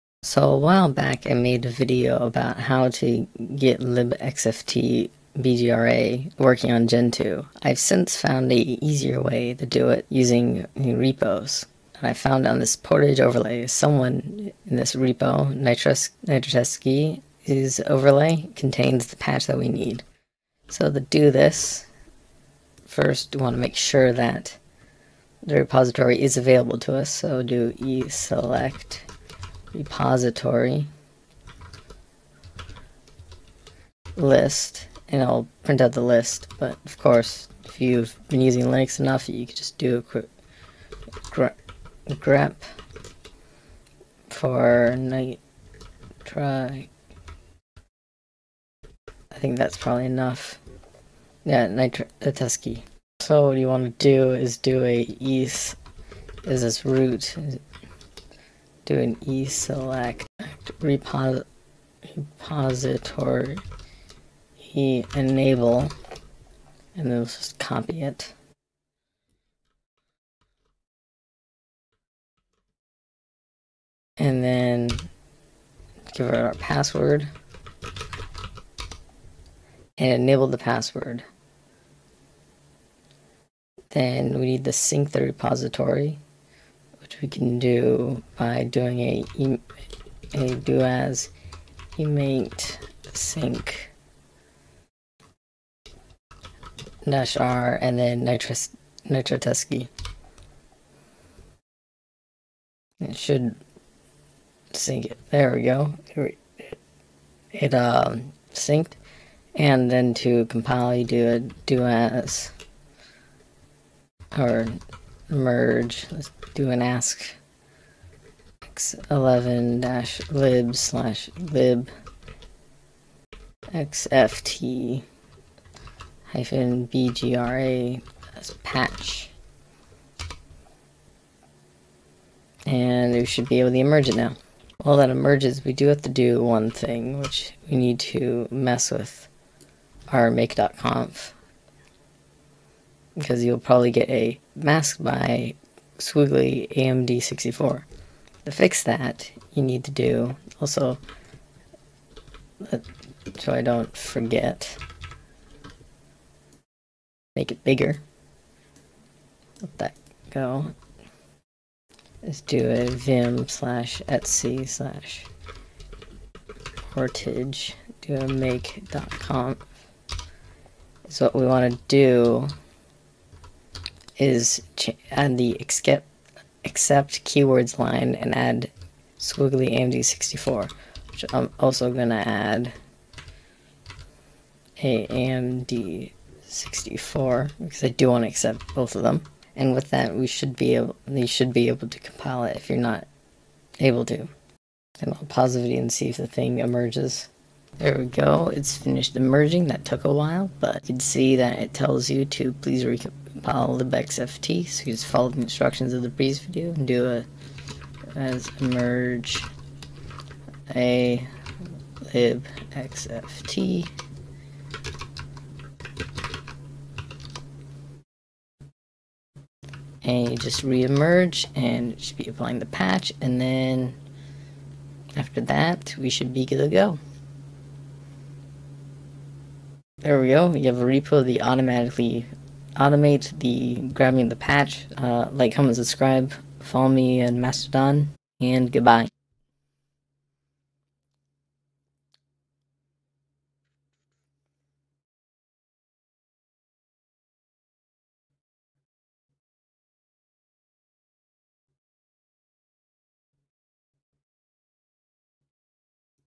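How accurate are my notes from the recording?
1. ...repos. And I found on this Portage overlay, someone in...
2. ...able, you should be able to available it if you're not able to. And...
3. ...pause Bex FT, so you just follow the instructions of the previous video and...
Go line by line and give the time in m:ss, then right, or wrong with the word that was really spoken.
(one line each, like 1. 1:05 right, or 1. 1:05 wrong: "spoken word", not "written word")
1. 0:10 right
2. 3:10 wrong: "compile", not "available"
3. 3:22 wrong: "please", not "pause".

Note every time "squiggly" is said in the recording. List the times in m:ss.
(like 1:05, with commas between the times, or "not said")
2:25, 2:59.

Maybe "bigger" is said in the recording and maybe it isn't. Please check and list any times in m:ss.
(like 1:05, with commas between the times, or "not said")
2:37.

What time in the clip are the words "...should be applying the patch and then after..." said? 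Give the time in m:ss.
3:42.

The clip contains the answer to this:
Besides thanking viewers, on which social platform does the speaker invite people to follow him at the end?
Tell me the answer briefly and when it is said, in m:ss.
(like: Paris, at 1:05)
Mastodon, at 3:57.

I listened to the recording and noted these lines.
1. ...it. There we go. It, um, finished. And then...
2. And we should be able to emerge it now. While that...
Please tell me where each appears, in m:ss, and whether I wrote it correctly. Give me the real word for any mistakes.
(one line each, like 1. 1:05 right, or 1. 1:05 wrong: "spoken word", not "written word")
1. 1:45 wrong: "synced", not "finished"
2. 2:12 right.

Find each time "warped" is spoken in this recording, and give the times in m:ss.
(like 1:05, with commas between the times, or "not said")
not said.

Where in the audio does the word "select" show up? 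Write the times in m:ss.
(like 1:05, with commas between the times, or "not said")
0:28, 0:59.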